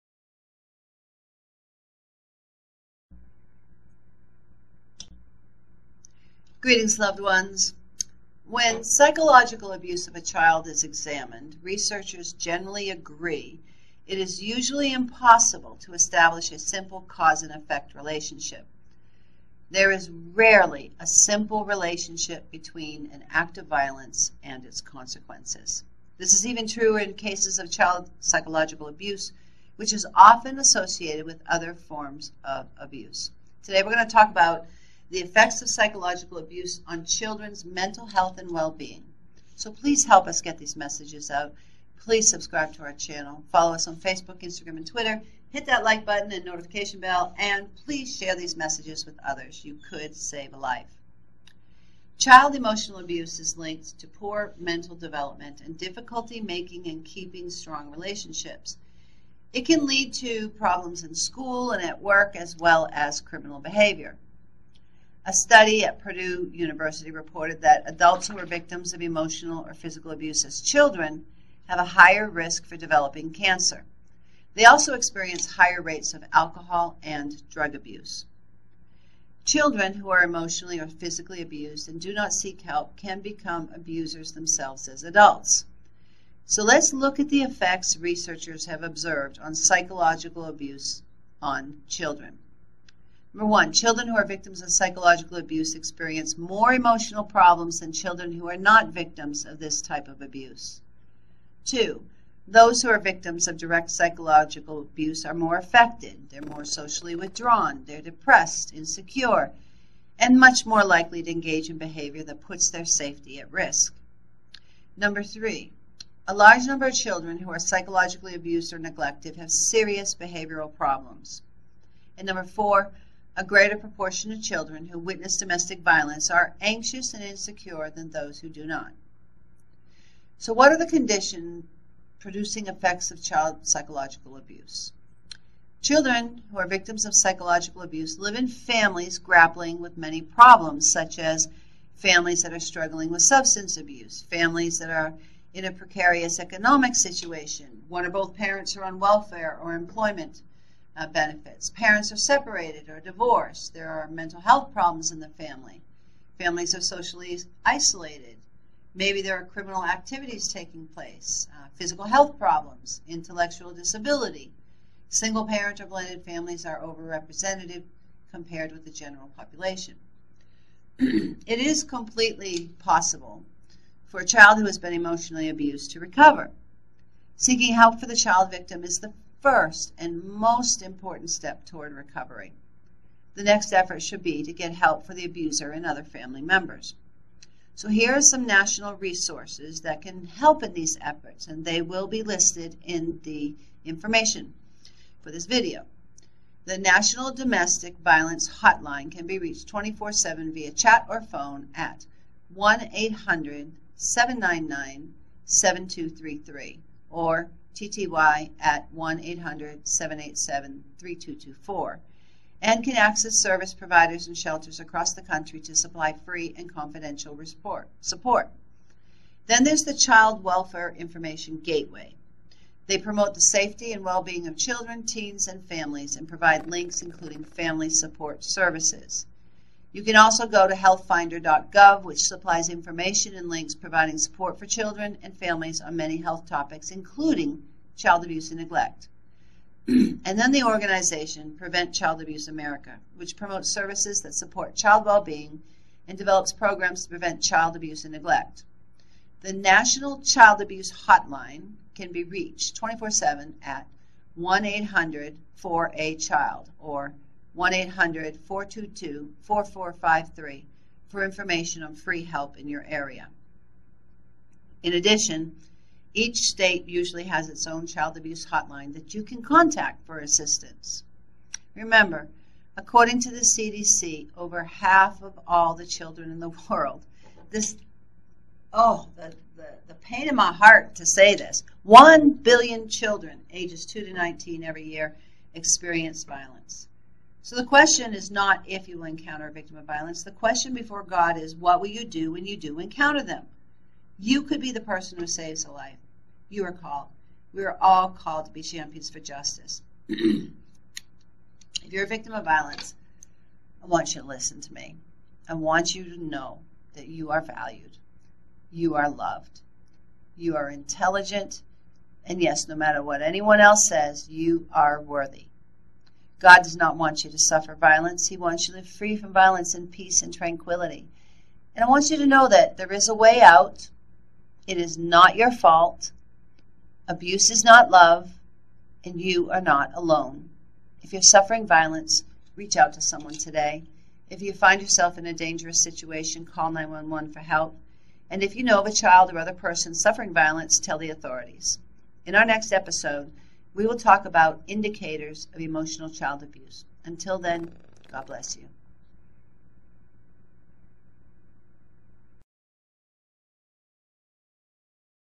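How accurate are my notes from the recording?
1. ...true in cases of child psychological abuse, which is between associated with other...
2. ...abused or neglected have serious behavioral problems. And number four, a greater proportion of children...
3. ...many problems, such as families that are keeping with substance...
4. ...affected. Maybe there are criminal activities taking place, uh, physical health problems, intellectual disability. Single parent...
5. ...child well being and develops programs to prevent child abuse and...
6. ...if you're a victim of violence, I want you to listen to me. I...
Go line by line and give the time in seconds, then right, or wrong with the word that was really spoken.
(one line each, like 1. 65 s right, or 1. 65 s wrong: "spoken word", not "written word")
1. 26 s wrong: "often", not "between"
2. 118 s right
3. 139 s wrong: "struggling", not "keeping"
4. 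157 s wrong: "isolated", not "affected"
5. 244 s right
6. 300 s right.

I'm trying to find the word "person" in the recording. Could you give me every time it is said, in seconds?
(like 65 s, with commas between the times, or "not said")
294 s, 339 s.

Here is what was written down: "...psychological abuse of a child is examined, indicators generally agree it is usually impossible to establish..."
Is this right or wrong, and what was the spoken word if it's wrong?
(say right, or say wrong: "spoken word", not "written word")
wrong: "researchers", not "indicators".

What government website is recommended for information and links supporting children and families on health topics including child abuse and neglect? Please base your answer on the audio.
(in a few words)
healthfinder.gov.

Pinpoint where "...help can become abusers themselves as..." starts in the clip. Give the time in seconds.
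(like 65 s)
82 s.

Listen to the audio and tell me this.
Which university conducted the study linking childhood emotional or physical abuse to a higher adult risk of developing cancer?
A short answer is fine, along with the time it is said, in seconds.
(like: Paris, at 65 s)
Purdue University, at 65 s.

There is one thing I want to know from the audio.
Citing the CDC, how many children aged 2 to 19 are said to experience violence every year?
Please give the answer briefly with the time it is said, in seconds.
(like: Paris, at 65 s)
1 billion, at 281 s.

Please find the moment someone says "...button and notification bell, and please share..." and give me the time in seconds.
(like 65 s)
46 s.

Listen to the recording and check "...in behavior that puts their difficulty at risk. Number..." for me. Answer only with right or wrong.
wrong.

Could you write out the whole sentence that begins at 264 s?
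In addition, each state usually has its own child abuse hotline that you can contact for assistance.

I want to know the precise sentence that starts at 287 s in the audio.
So the question is not if you will encounter a victim of violence.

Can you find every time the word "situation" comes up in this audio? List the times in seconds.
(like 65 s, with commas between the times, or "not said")
146 s, 335 s.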